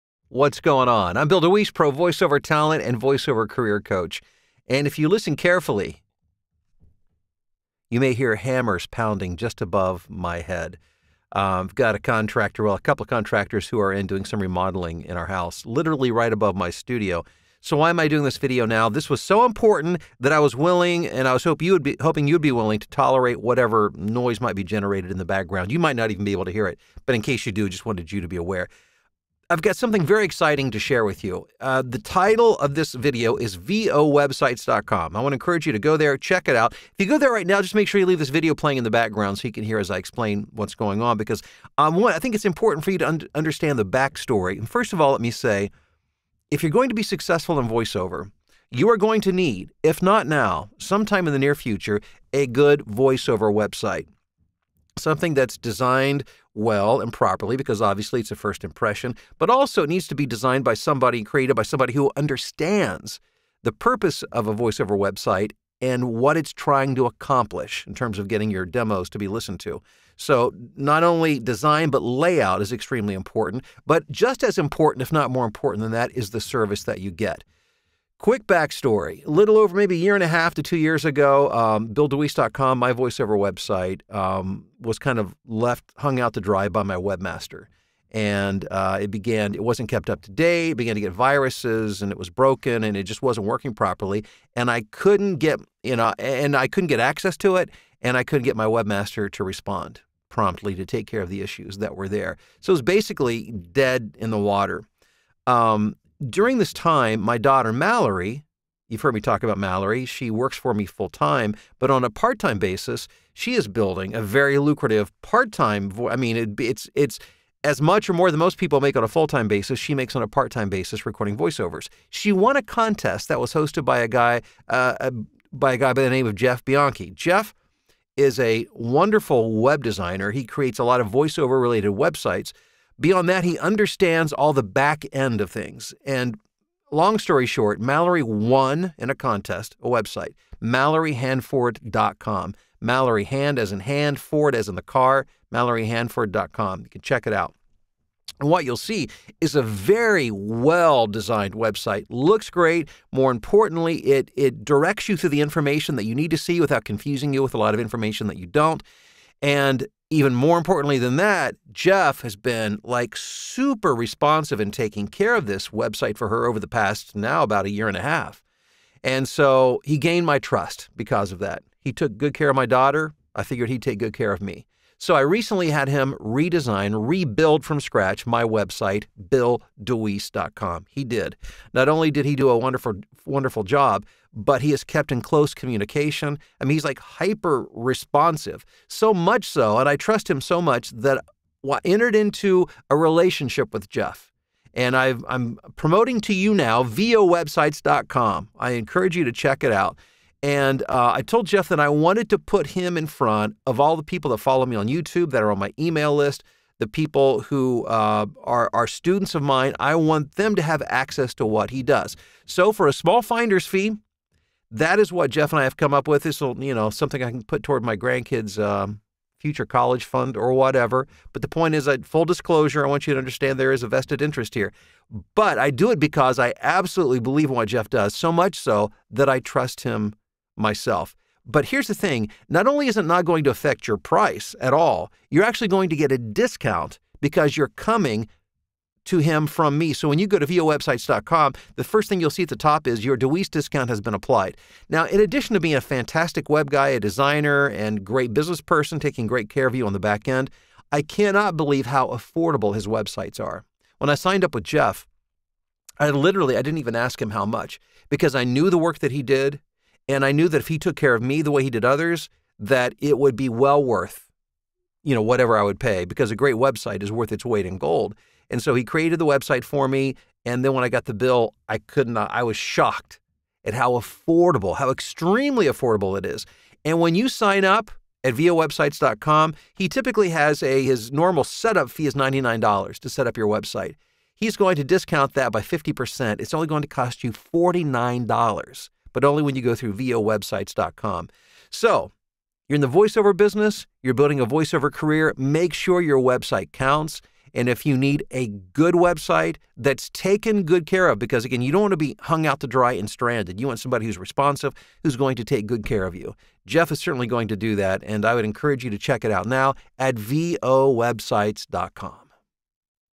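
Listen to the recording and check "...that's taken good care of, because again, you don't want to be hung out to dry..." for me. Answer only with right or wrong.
right.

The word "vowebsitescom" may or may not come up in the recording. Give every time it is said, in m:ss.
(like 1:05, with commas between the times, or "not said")
0:33, 3:16, 4:00, 4:38, 4:49, 5:10.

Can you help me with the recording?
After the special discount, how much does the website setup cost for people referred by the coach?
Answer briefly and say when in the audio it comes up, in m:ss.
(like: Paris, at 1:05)
$49, at 4:47.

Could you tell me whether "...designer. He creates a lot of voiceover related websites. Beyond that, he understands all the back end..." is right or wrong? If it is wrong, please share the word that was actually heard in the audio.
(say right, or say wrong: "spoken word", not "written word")
right.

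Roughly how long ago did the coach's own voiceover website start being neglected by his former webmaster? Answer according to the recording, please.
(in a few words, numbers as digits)
a year and a half to two years.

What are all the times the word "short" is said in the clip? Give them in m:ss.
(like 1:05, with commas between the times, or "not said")
2:17.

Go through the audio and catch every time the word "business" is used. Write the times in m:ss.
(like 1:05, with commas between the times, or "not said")
4:08, 4:53.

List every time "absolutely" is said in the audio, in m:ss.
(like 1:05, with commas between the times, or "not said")
3:46.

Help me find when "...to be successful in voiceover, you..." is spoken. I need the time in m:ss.
0:46.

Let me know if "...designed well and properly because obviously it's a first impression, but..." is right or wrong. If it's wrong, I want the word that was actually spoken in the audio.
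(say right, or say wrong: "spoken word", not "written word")
right.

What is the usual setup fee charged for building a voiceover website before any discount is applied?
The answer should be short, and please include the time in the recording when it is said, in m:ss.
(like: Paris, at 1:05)
$99, at 4:42.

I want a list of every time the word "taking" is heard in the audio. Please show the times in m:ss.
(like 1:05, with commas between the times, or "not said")
2:44, 4:08.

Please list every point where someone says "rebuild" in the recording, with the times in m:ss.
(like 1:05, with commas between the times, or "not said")
2:57.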